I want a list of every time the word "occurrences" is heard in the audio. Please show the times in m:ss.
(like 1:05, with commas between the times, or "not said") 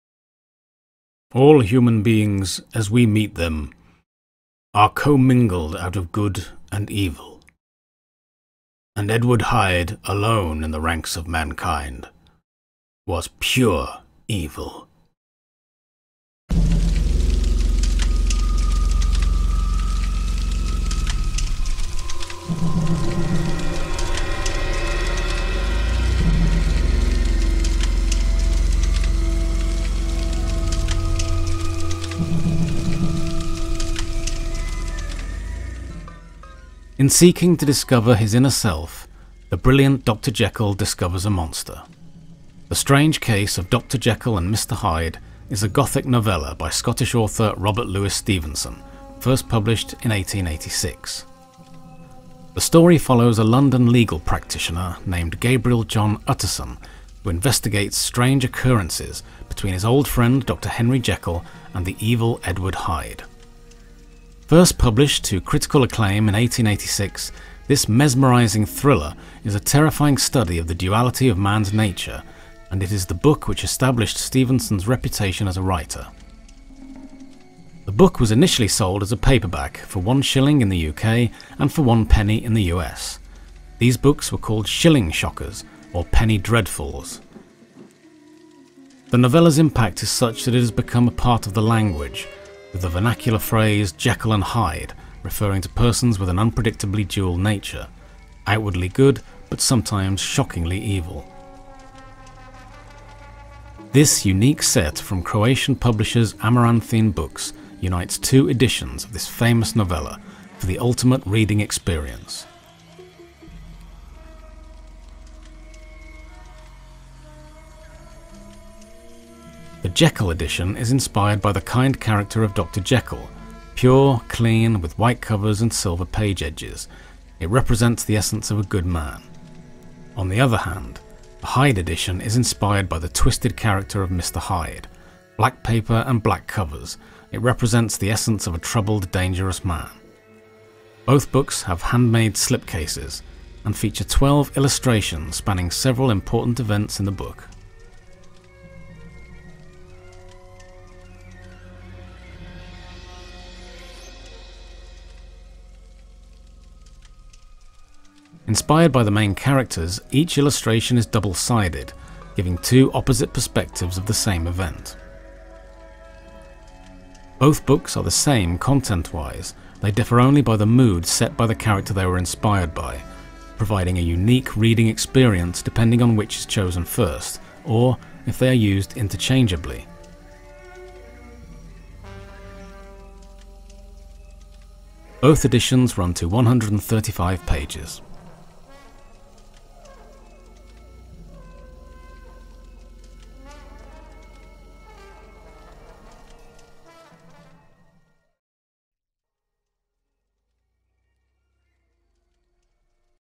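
0:58.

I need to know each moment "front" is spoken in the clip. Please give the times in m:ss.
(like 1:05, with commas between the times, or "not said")
not said.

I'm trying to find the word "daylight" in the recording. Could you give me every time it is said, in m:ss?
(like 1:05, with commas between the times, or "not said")
not said.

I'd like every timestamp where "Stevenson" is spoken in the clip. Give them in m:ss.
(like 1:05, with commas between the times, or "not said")
0:48, 1:14.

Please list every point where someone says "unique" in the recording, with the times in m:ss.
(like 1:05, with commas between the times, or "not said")
1:44, 2:54.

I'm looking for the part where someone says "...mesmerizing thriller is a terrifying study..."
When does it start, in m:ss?
1:07.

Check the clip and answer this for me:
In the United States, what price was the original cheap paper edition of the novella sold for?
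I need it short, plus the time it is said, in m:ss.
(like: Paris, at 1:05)
One penny, at 1:21.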